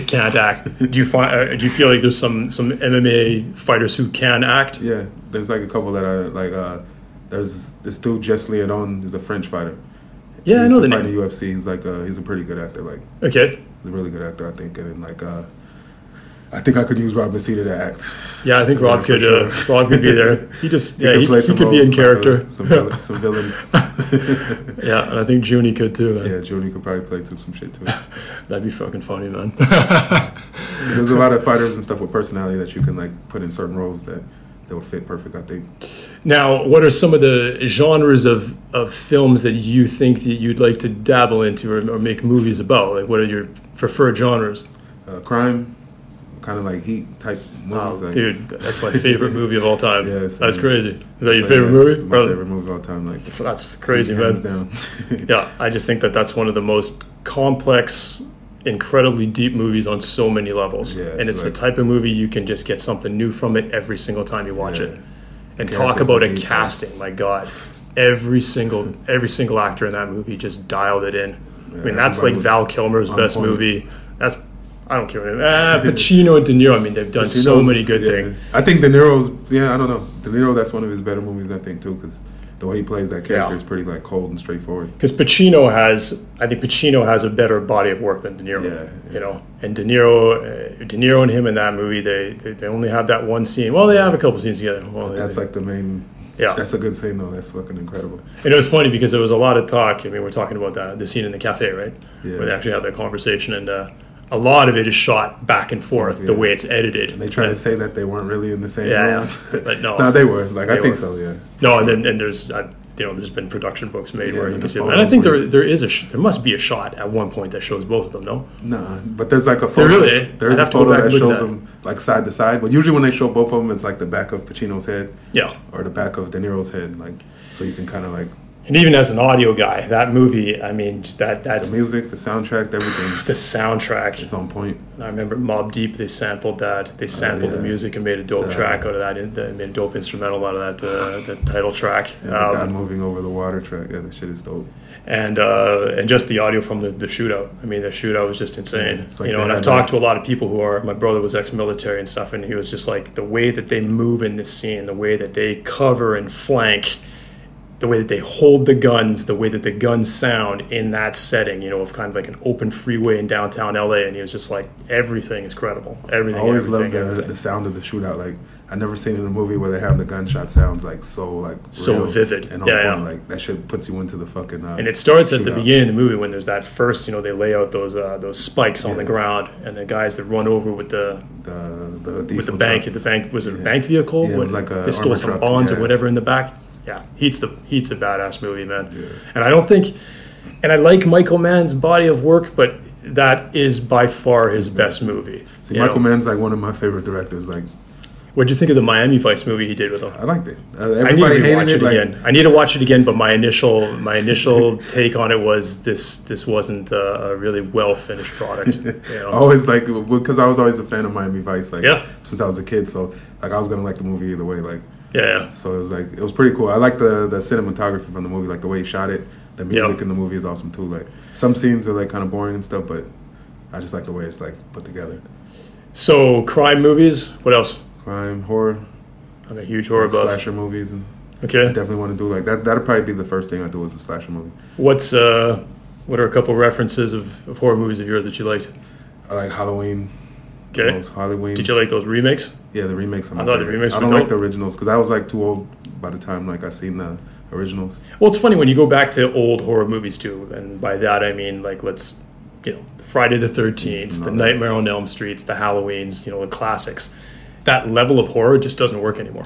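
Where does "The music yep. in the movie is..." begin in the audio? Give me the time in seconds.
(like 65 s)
219 s.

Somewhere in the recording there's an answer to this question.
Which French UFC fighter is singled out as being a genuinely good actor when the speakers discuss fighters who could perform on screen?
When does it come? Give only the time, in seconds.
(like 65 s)
8 s.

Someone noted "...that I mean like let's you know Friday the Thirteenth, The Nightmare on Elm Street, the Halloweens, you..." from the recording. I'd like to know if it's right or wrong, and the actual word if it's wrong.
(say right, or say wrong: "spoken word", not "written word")
right.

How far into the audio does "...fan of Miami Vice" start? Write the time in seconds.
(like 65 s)
210 s.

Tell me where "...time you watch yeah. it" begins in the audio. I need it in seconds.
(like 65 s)
64 s.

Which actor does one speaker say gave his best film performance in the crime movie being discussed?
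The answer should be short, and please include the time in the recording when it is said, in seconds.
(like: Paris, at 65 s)
Val Kilmer, at 72 s.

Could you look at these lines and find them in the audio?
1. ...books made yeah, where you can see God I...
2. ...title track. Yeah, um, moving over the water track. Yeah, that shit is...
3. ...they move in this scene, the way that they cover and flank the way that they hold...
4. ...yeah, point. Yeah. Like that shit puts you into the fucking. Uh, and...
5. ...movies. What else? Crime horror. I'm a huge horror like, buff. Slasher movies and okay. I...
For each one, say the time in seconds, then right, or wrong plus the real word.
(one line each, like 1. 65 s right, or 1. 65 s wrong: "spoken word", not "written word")
1. 113 s wrong: "And", not "God"
2. 141 s right
3. 153 s right
4. 172 s right
5. 226 s right.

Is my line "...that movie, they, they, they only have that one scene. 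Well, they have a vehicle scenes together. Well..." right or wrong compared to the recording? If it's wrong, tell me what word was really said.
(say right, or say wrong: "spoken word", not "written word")
wrong: "couple", not "vehicle".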